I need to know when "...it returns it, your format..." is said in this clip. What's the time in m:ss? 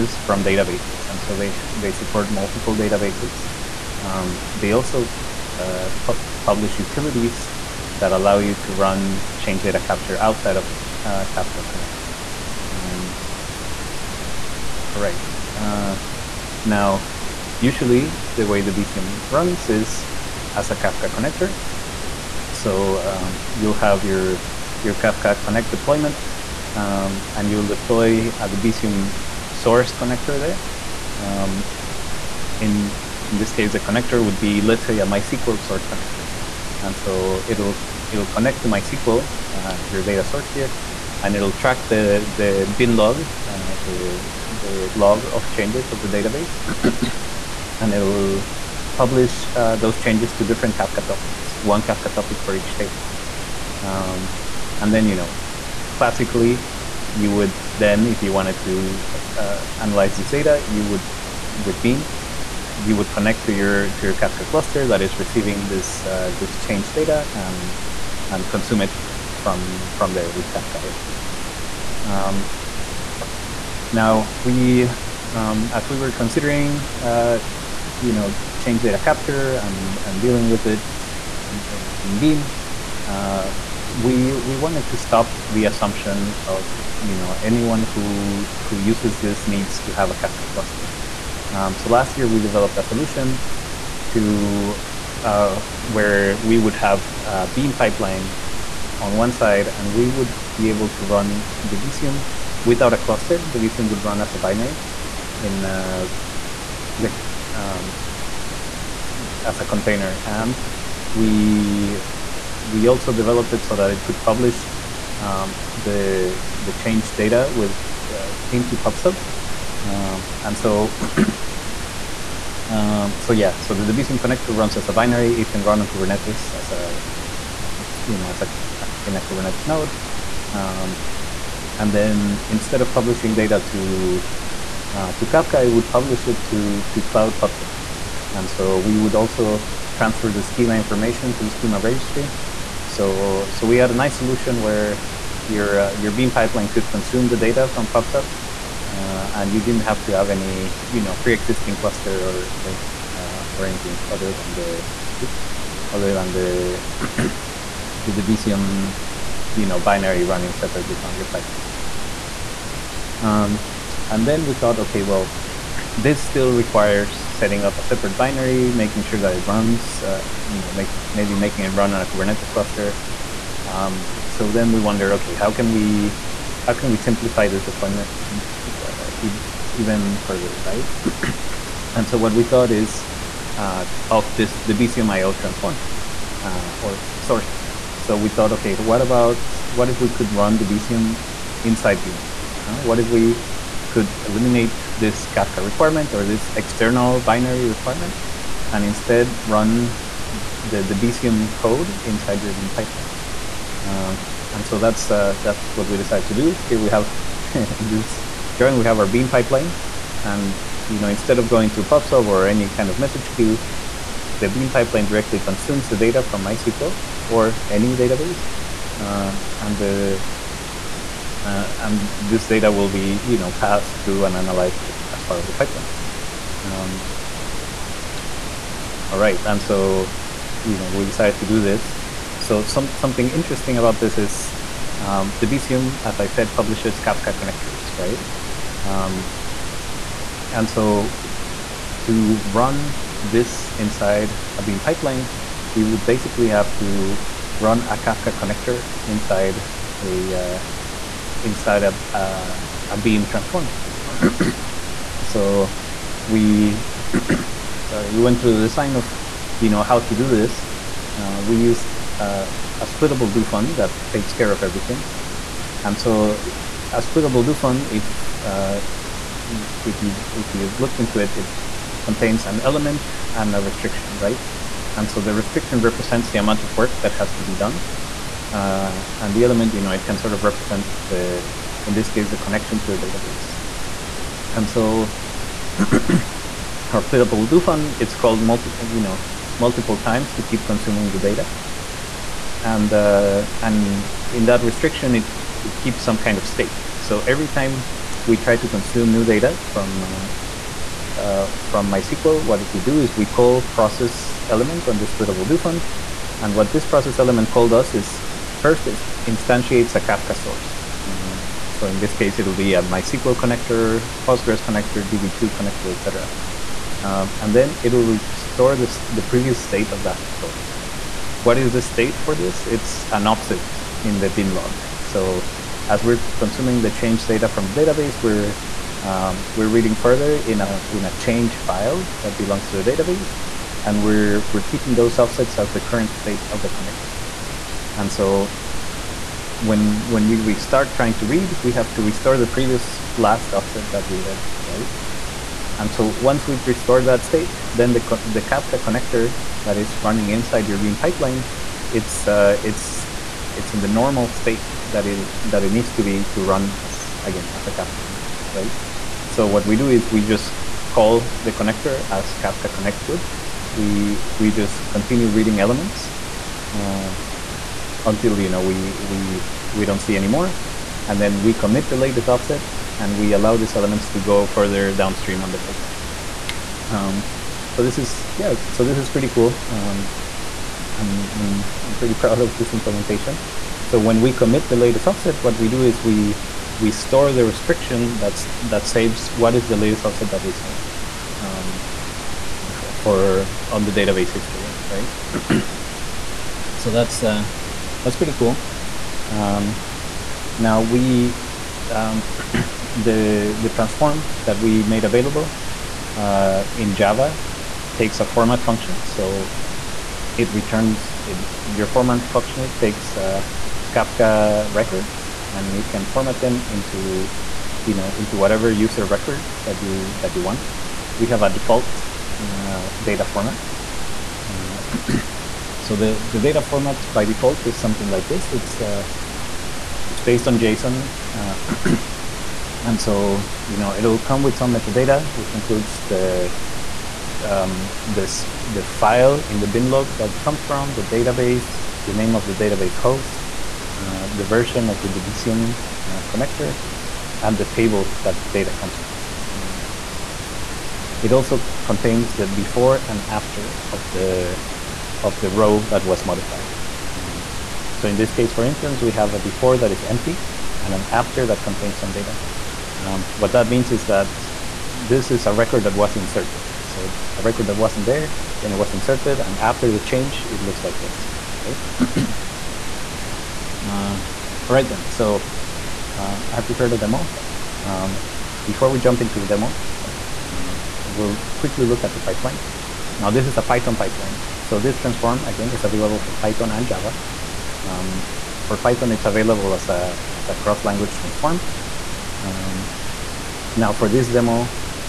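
6:50.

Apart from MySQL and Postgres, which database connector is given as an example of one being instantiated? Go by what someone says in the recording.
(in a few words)
DB2.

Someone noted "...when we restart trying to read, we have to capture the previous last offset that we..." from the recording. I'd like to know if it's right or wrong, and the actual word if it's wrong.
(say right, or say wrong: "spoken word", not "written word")
wrong: "restore", not "capture".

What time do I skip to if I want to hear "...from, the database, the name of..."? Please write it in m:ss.
7:20.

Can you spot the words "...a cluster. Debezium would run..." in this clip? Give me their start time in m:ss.
1:42.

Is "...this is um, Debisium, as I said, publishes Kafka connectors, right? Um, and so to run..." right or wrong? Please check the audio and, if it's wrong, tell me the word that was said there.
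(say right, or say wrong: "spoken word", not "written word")
right.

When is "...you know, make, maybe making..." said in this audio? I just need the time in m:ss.
2:50.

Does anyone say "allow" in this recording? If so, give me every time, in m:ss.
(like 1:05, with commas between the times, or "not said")
0:08, 6:13.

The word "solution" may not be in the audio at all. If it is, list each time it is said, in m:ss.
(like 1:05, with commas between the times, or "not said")
1:32, 2:24.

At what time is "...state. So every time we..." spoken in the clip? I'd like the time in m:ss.
4:56.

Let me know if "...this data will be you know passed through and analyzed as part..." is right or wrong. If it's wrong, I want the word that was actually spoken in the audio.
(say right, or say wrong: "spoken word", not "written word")
right.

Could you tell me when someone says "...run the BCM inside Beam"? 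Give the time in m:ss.
3:10.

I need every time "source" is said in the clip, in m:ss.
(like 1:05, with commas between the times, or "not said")
0:29, 0:35, 0:40, 3:07, 5:10, 5:20.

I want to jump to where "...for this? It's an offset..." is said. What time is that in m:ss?
5:22.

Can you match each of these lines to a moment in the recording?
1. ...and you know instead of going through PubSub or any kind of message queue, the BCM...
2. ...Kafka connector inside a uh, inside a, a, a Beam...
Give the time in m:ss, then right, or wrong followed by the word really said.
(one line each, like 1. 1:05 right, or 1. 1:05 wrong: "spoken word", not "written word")
1. 3:30 wrong: "Beam", not "BCM"
2. 4:07 right.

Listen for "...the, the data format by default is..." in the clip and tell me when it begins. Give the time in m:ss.
7:05.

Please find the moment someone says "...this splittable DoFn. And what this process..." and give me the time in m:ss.
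5:04.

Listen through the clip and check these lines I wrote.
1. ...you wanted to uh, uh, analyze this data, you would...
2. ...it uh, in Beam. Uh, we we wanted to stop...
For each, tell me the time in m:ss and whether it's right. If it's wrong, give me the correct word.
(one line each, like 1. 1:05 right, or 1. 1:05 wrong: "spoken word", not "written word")
1. 0:58 right
2. 1:20 right.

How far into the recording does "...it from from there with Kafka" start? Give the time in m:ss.
1:08.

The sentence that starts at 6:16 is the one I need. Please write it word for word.
Um, so this is, yeah, so this is pretty cool.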